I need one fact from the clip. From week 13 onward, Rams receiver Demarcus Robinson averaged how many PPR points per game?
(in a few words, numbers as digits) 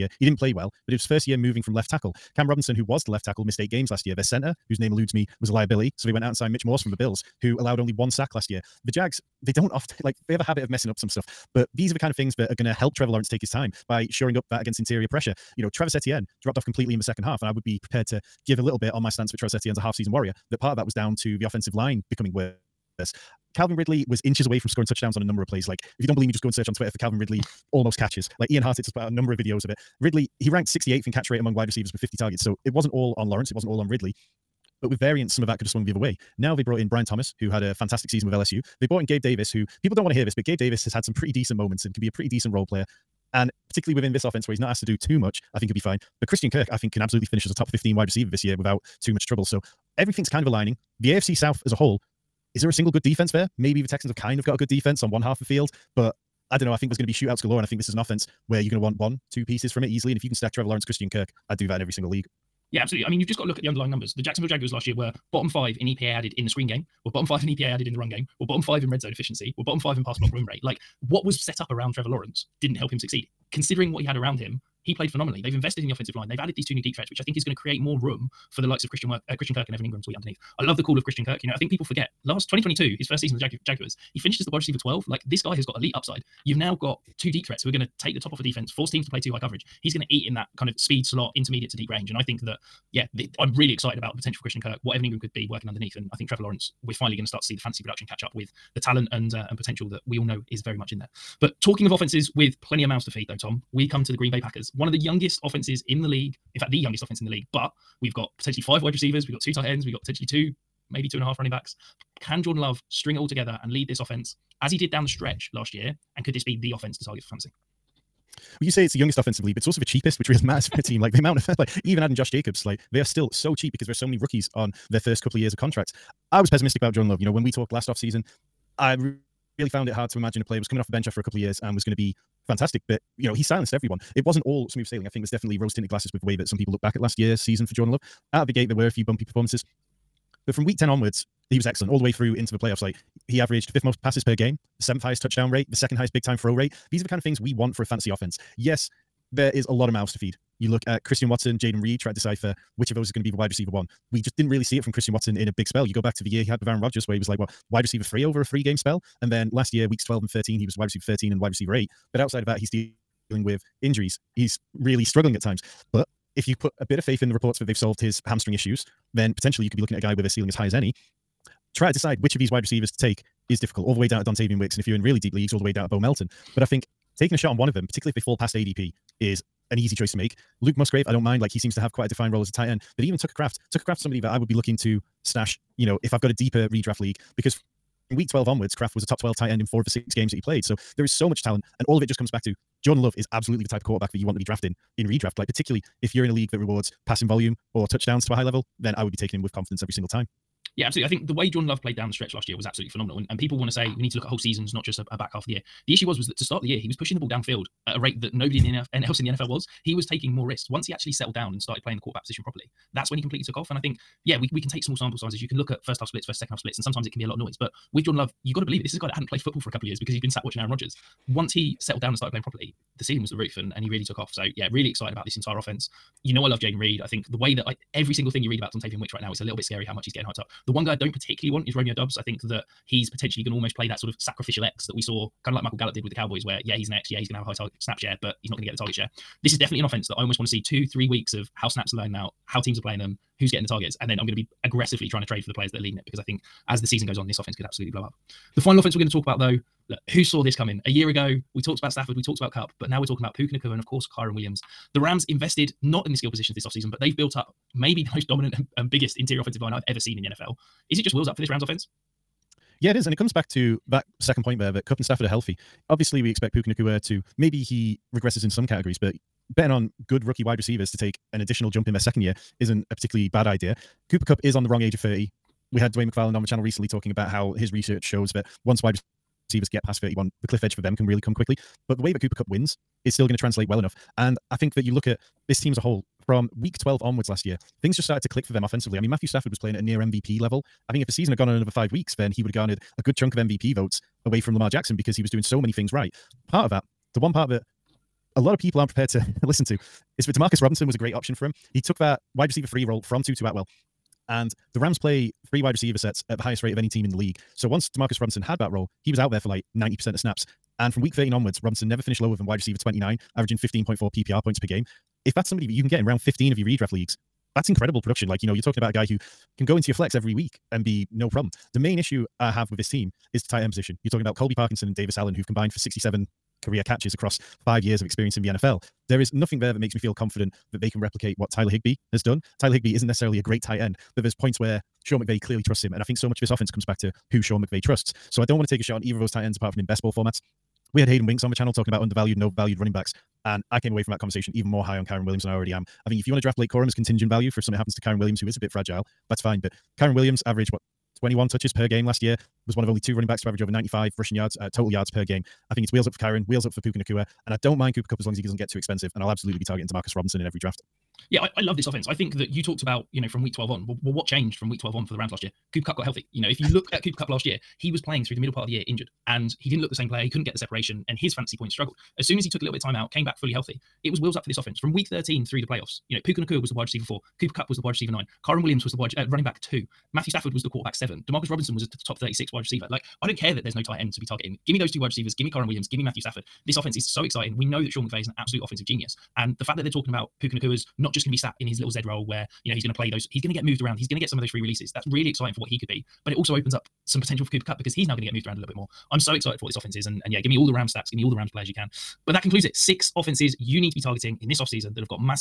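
15.4.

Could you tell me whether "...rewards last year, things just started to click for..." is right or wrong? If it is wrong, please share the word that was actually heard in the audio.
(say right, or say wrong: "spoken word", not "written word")
wrong: "onwards", not "rewards".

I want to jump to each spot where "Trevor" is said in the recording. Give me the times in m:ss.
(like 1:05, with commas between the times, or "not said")
0:12, 1:00, 1:11, 1:36.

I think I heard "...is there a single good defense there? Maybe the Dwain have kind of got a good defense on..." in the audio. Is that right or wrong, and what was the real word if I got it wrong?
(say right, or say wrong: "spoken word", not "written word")
wrong: "Texans", not "Dwain".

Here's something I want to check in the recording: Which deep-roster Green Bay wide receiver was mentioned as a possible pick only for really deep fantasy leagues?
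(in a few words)
Bo Melton.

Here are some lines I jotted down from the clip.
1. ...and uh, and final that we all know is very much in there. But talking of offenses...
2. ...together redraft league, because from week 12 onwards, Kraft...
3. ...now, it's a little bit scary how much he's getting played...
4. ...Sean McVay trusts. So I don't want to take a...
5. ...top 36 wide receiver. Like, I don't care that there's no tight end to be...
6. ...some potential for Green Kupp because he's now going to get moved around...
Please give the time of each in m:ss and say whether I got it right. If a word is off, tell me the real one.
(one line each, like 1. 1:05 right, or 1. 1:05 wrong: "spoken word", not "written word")
1. 1:39 wrong: "potential", not "final"
2. 3:06 wrong: "deeper", not "together"
3. 3:49 wrong: "hyped", not "played"
4. 5:37 right
5. 6:22 right
6. 6:37 wrong: "Cooper", not "Green".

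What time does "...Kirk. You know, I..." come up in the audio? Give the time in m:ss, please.
1:21.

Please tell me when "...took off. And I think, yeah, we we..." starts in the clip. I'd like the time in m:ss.
3:33.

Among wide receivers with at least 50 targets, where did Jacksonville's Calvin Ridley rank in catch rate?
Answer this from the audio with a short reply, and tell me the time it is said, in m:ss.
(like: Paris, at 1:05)
68th, at 0:30.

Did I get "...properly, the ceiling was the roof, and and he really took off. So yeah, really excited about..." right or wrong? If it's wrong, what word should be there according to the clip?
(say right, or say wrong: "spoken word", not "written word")
right.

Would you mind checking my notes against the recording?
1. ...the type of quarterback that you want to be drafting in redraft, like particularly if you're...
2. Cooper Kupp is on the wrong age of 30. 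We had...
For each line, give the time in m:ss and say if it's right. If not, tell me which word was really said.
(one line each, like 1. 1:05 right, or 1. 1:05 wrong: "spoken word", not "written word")
1. 3:13 right
2. 4:34 right.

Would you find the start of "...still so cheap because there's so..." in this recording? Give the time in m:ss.
2:03.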